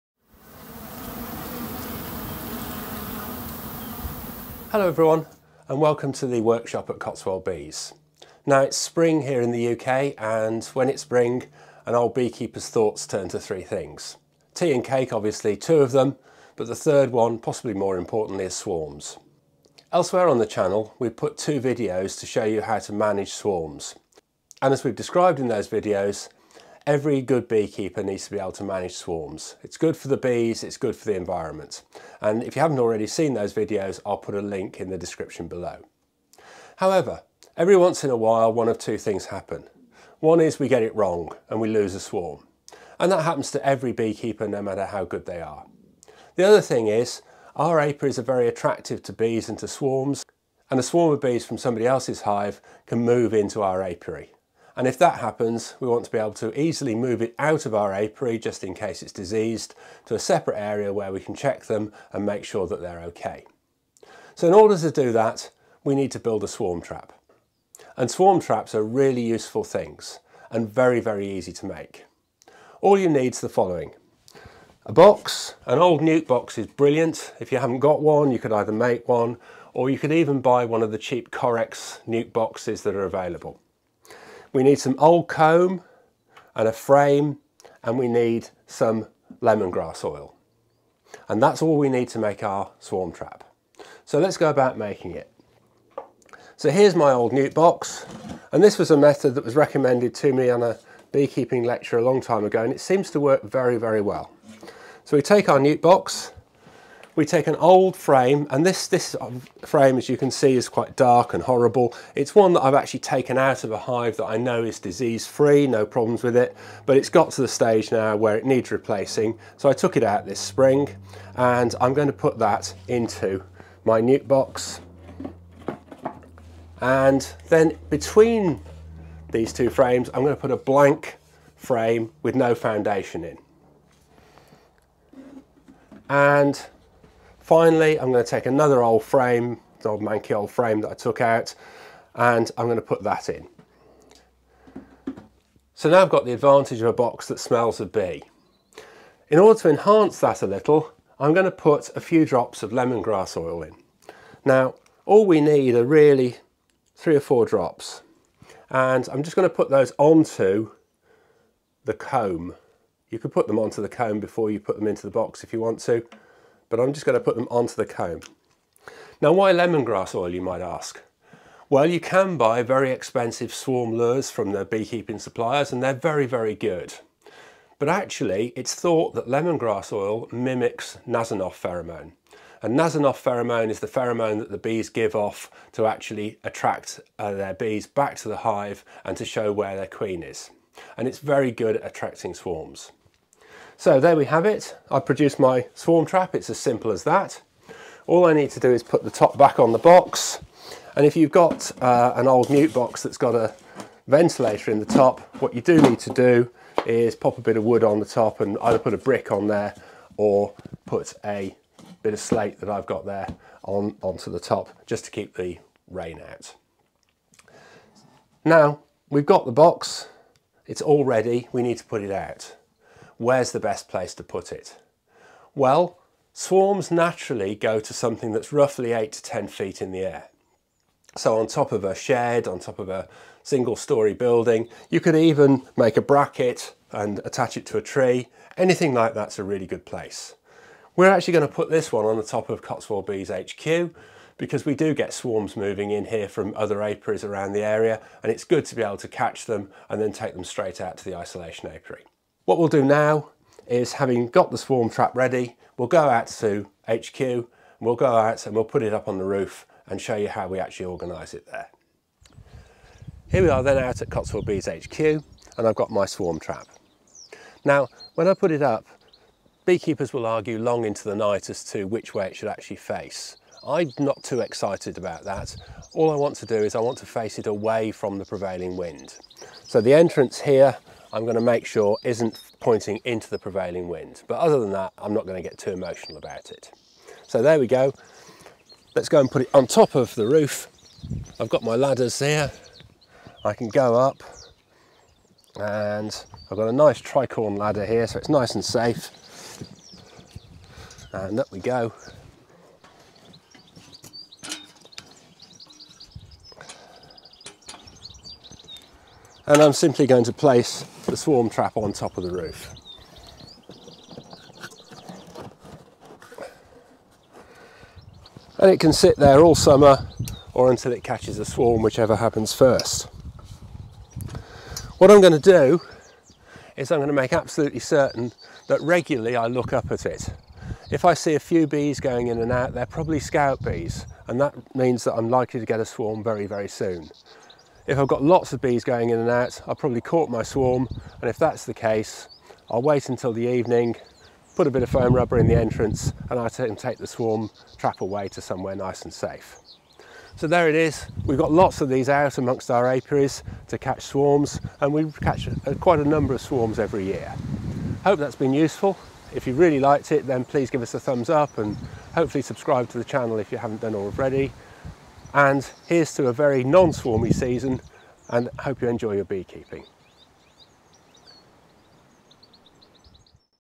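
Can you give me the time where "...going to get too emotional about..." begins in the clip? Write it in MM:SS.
04:45.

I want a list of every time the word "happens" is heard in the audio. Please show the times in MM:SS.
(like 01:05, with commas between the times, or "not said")
00:39, 00:43, 00:55, 05:22.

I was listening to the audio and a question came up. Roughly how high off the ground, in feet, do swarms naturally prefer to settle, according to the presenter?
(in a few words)
8 to 10 feet.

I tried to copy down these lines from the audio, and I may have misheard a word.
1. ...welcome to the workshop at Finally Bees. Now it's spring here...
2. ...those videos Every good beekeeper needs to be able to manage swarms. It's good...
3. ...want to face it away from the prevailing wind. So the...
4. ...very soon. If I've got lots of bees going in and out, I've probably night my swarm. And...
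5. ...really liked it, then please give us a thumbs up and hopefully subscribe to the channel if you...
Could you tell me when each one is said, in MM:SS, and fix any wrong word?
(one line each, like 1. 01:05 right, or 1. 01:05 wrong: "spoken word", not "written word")
1. 00:05 wrong: "Cotswold", not "Finally"
2. 00:25 right
3. 04:36 right
4. 05:36 wrong: "caught", not "night"
5. 05:59 right.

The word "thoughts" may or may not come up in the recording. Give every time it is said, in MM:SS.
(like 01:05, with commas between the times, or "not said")
00:12, 02:58.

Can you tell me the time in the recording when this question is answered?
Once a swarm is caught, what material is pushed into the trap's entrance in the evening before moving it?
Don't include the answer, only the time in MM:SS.
05:44.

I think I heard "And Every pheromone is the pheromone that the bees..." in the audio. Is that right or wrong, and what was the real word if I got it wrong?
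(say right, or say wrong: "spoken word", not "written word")
wrong: "Nasonov", not "Every".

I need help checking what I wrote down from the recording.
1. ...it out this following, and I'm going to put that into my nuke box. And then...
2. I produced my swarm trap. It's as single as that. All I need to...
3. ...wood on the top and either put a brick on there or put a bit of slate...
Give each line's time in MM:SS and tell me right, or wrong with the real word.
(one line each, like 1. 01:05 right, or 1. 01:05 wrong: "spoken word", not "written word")
1. 01:59 wrong: "spring", not "following"
2. 03:14 wrong: "simple", not "single"
3. 03:27 right.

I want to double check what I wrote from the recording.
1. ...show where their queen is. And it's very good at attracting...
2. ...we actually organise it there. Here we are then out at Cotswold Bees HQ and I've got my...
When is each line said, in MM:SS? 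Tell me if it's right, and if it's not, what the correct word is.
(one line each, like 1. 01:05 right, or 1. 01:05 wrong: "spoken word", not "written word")
1. 03:09 right
2. 04:20 right.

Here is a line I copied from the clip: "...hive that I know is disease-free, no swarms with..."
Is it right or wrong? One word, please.
wrong.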